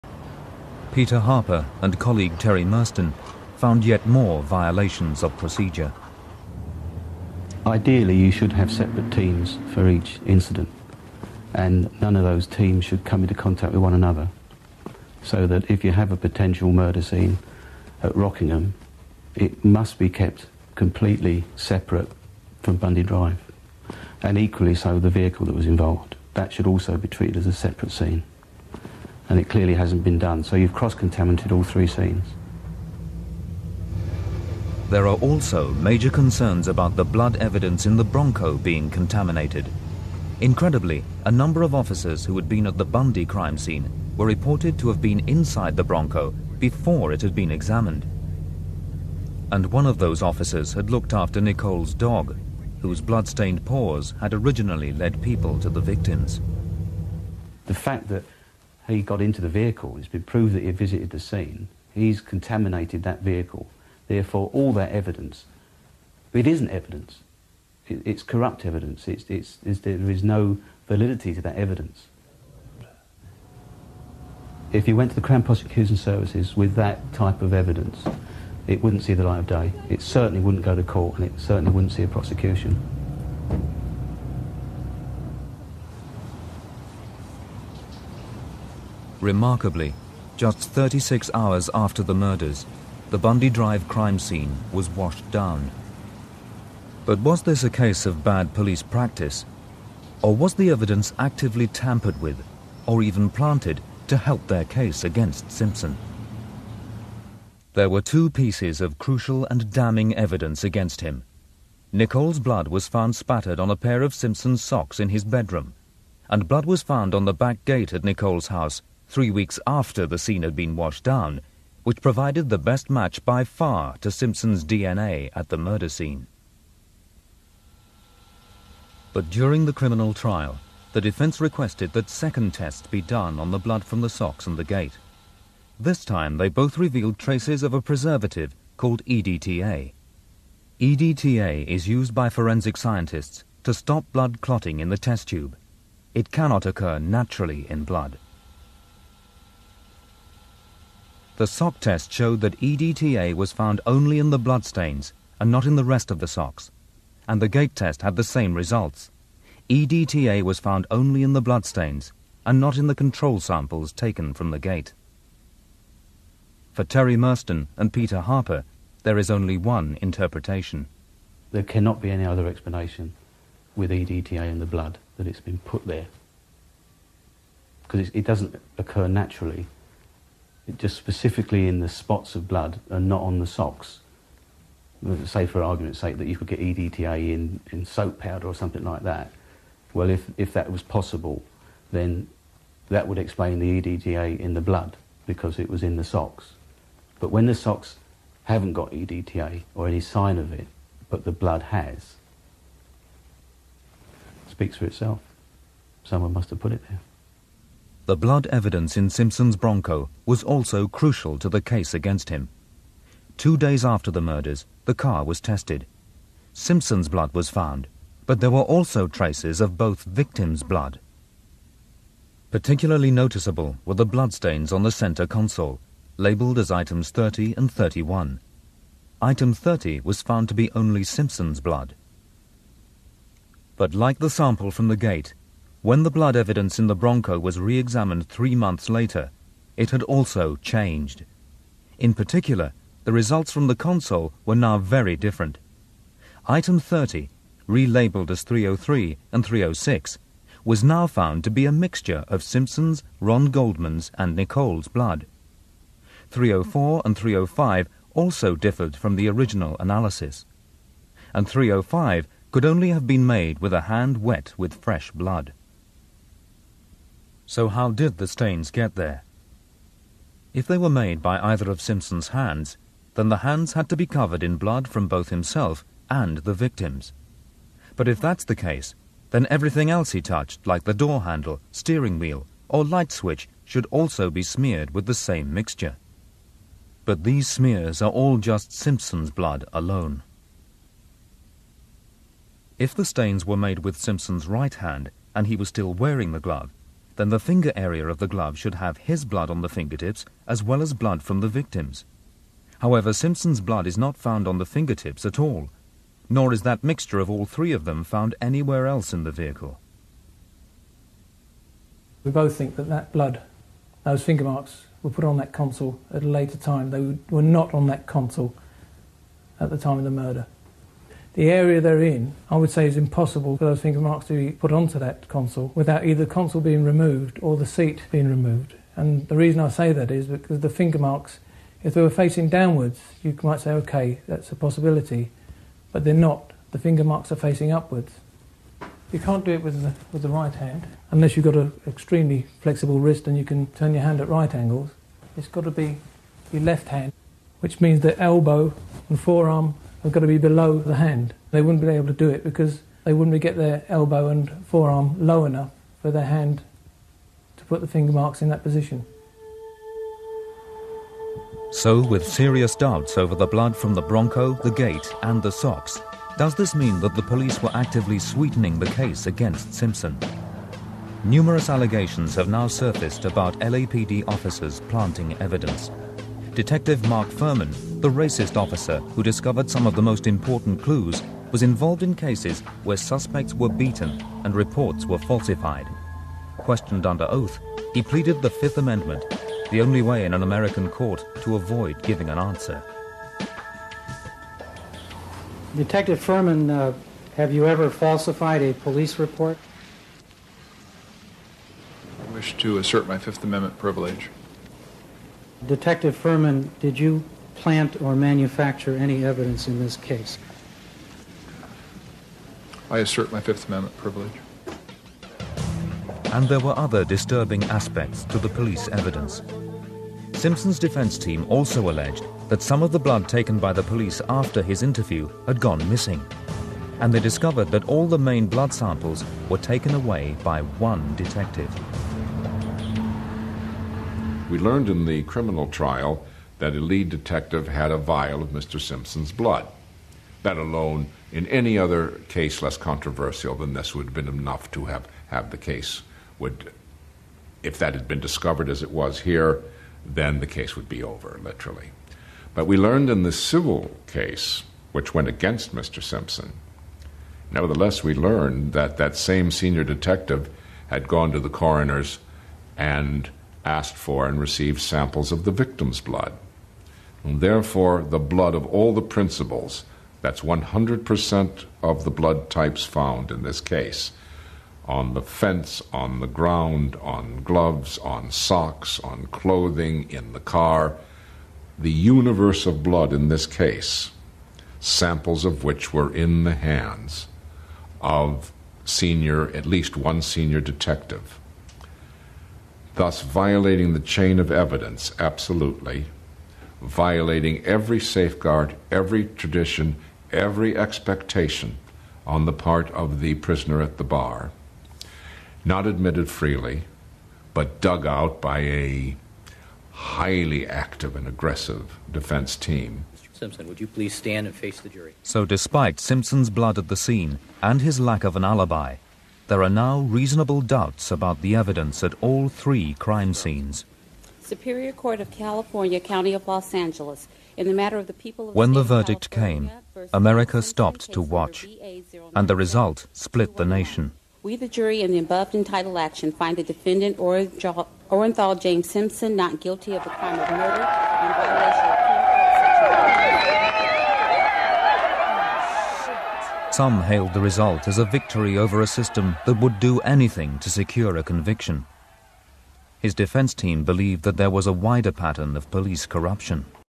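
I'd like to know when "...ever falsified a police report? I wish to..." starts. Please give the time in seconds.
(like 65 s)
397 s.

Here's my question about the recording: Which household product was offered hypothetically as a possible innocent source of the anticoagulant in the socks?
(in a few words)
Soap powder.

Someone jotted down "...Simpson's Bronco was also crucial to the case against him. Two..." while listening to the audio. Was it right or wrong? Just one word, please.
right.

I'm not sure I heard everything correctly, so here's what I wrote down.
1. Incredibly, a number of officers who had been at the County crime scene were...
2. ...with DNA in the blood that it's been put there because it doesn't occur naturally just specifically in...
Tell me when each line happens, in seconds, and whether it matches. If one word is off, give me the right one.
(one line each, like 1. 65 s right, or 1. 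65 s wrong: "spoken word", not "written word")
1. 40 s wrong: "Bundy", not "County"
2. 173 s wrong: "EDTA", not "DNA".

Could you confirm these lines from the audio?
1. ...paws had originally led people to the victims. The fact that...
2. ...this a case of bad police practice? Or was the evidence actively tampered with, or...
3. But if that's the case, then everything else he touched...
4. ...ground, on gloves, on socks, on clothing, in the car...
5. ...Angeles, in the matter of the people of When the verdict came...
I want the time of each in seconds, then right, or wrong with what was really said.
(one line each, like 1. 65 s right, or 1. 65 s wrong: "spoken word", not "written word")
1. 53 s right
2. 97 s right
3. 277 s right
4. 476 s right
5. 526 s right.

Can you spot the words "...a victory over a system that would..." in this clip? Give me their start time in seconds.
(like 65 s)
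547 s.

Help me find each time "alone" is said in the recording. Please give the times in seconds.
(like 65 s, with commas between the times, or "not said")
289 s, 440 s.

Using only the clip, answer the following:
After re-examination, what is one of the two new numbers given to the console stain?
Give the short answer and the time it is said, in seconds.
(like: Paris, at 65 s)
303 or 306, at 248 s.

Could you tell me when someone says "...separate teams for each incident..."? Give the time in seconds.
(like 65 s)
8 s.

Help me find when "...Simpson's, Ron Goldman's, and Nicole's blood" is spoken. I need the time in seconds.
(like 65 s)
252 s.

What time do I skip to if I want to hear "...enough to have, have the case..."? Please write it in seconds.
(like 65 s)
444 s.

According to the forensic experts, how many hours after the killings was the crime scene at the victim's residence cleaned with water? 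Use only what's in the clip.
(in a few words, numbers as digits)
36 hours.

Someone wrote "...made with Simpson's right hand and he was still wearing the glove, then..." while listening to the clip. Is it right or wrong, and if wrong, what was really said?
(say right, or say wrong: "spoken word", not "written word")
right.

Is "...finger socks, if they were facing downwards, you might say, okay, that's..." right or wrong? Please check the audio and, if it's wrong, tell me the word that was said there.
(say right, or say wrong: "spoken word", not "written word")
wrong: "marks", not "socks".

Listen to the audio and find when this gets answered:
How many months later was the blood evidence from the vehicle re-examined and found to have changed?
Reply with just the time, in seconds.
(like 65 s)
238 s.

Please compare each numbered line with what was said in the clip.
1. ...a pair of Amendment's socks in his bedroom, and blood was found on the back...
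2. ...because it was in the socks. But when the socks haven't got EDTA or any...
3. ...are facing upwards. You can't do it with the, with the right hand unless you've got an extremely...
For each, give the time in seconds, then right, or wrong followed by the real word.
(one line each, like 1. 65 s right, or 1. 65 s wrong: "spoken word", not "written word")
1. 113 s wrong: "Simpson", not "Amendment"
2. 195 s right
3. 337 s right.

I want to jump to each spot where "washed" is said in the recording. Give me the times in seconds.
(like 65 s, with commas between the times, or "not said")
94 s, 120 s.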